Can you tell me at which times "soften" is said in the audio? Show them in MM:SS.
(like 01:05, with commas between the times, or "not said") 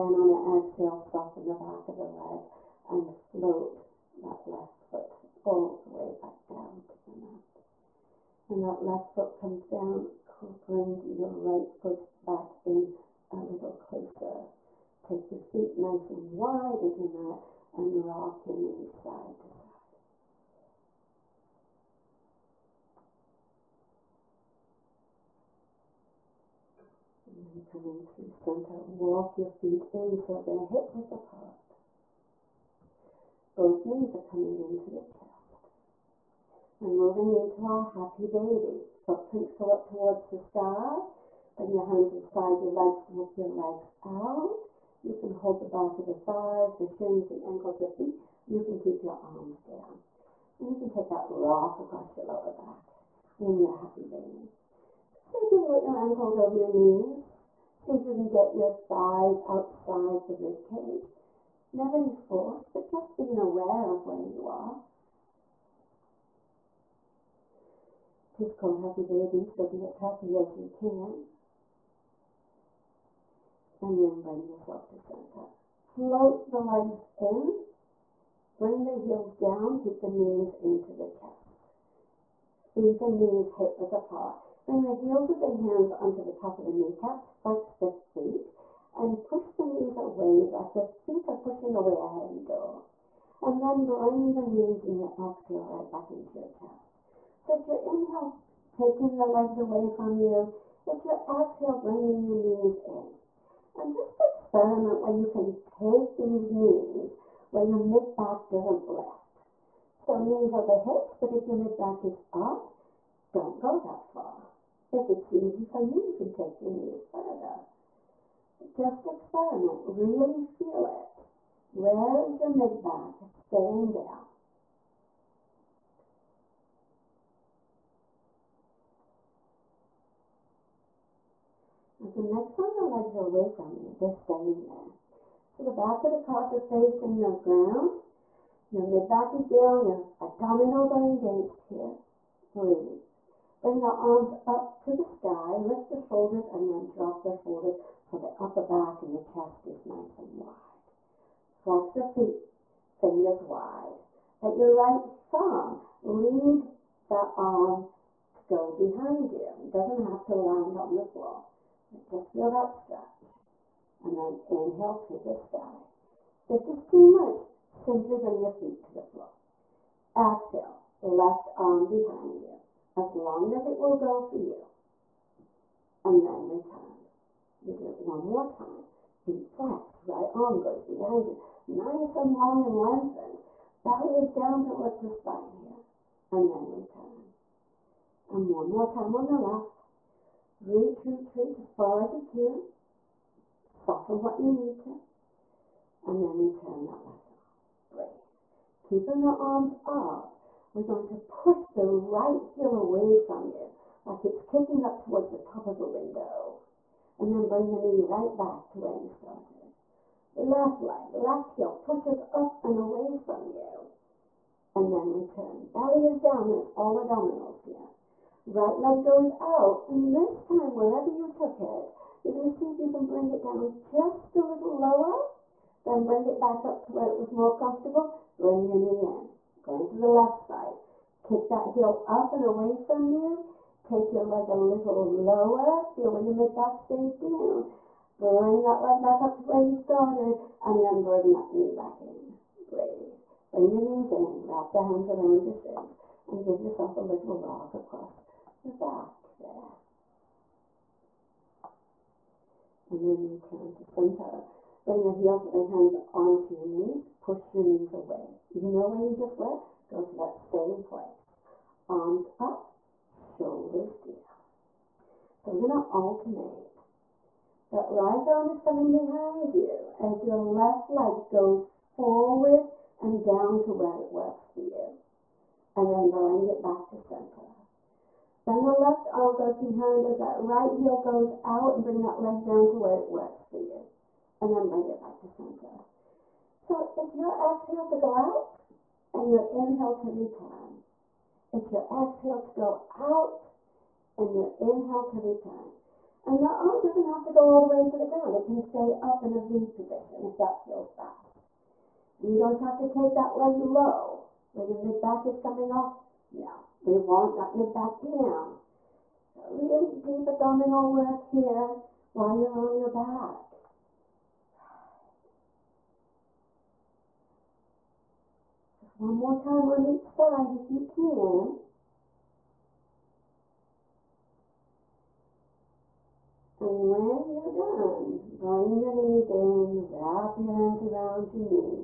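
00:00, 03:13.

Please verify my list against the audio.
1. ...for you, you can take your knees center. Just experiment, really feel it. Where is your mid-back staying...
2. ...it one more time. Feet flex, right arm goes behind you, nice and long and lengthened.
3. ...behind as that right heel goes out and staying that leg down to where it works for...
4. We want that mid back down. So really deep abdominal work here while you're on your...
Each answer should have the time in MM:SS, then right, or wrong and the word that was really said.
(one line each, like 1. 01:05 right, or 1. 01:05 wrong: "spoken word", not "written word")
1. 01:55 wrong: "further", not "center"
2. 02:57 right
3. 04:39 wrong: "bring", not "staying"
4. 05:06 right.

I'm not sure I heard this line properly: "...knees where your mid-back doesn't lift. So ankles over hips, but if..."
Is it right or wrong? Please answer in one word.
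wrong.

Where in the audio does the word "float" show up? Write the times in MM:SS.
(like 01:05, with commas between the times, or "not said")
00:03, 01:15.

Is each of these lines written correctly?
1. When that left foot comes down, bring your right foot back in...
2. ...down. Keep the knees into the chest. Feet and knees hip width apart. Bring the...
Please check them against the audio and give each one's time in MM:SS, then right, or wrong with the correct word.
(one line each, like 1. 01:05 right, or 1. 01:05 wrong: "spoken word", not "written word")
1. 00:08 right
2. 01:19 right.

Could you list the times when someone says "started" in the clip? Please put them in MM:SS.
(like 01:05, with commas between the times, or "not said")
03:29, 03:59.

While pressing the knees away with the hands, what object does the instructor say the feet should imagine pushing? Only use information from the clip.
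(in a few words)
a heavy door.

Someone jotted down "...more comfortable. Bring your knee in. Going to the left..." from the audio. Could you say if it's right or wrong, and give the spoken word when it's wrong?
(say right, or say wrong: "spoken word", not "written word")
right.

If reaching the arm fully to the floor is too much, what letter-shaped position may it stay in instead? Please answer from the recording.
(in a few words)
V.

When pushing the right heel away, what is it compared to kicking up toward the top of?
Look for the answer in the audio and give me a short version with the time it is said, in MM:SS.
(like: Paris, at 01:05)
a window, at 03:25.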